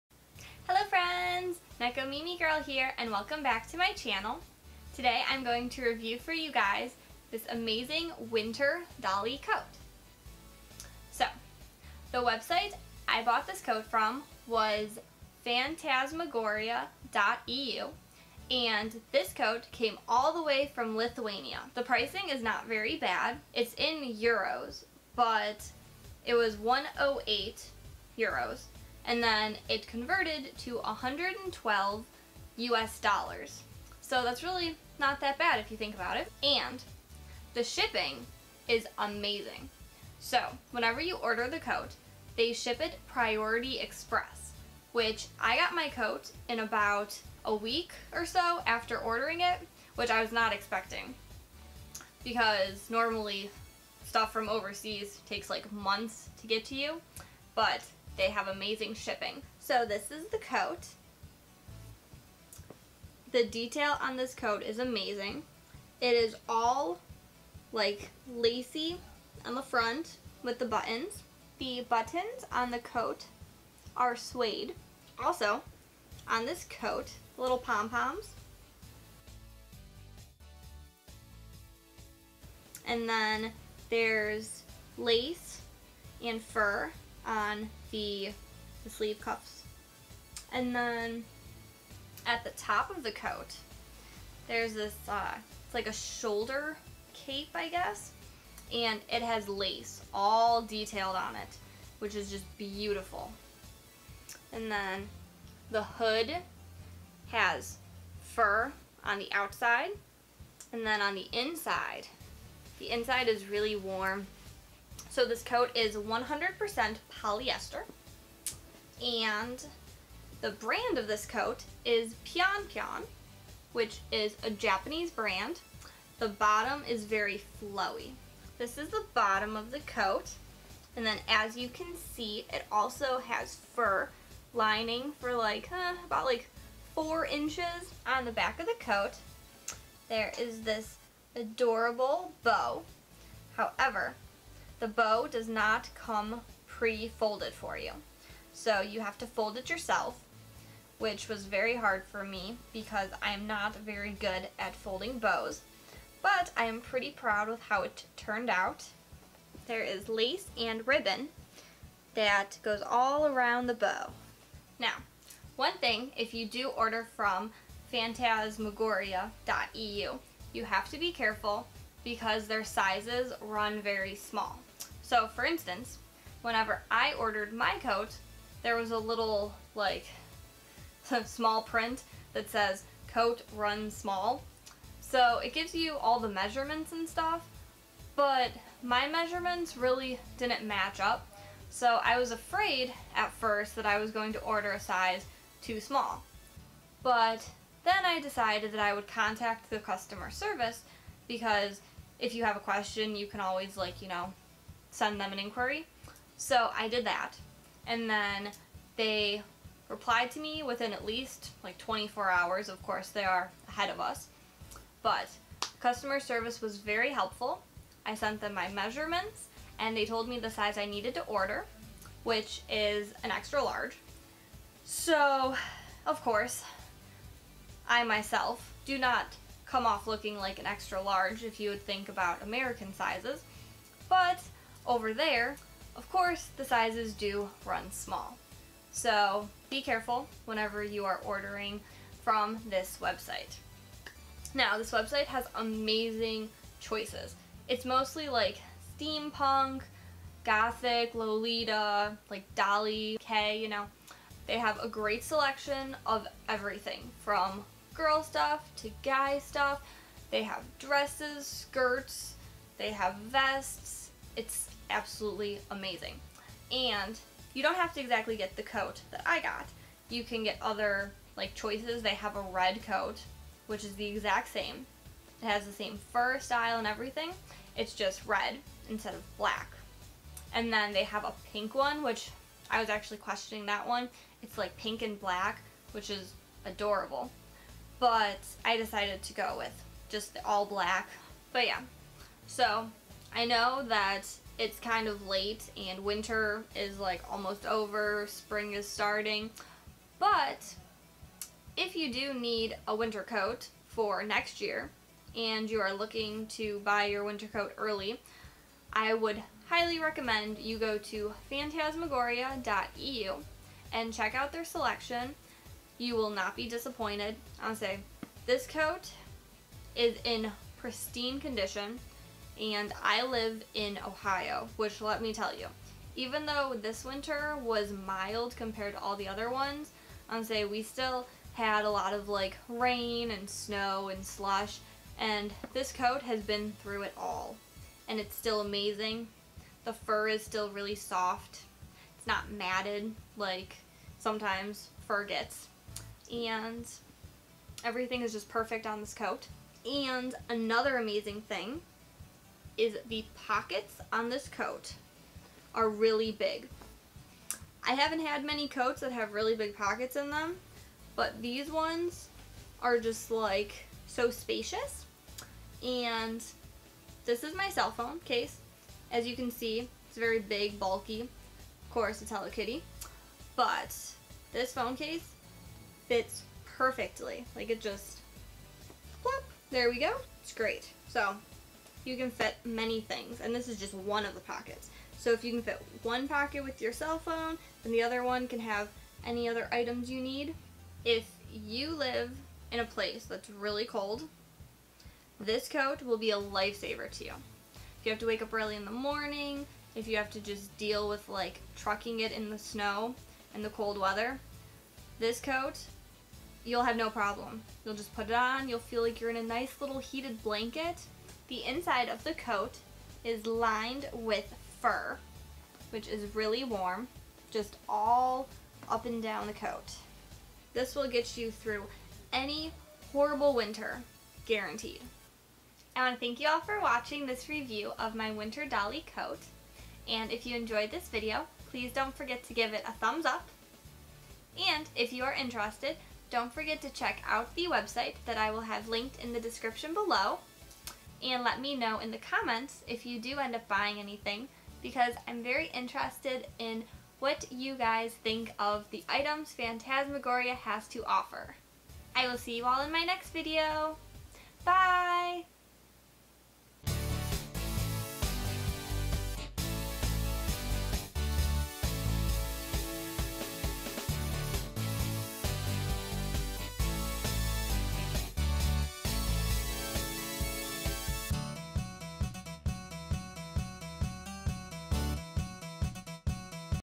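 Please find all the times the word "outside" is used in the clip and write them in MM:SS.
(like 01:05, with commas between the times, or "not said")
01:49.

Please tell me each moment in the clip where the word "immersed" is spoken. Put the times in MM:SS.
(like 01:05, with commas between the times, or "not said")
not said.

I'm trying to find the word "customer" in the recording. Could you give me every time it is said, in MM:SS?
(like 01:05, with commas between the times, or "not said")
03:19, 03:35.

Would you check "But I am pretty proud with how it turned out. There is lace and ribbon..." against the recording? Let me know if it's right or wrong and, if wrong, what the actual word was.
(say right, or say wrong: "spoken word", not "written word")
right.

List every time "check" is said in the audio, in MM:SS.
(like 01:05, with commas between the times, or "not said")
05:14, 07:16.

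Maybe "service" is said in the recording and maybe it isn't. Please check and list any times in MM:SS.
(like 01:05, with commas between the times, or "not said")
03:20, 03:36.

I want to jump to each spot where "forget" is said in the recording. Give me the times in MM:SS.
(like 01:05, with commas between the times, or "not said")
07:12, 07:16.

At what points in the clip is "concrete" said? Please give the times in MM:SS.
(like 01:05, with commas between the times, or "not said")
not said.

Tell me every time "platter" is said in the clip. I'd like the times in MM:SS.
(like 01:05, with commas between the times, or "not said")
not said.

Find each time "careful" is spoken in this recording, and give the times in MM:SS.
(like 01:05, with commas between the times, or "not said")
02:51, 03:59.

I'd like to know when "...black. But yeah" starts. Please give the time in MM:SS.
04:50.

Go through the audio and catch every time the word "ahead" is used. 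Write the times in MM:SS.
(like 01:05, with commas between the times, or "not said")
03:33.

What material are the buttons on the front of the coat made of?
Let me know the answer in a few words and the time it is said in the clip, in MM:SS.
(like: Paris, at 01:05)
Suede, at 01:14.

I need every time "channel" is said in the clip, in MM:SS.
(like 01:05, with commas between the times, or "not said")
00:03.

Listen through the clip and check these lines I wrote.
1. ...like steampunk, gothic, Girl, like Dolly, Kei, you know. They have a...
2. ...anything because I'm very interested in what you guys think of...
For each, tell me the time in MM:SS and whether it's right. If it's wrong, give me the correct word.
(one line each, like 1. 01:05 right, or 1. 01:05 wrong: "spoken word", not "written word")
1. 04:08 wrong: "Lolita", not "Girl"
2. 07:23 right.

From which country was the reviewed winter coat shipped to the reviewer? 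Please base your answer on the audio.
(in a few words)
Lithuania.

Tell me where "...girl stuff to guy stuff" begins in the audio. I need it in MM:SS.
04:17.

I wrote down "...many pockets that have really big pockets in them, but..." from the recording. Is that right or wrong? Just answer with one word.
wrong.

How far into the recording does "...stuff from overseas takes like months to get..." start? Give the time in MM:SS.
00:54.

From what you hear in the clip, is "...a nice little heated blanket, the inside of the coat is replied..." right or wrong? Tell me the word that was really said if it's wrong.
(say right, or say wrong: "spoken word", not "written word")
wrong: "lined", not "replied".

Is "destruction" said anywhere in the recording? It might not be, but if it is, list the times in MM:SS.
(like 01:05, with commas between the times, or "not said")
not said.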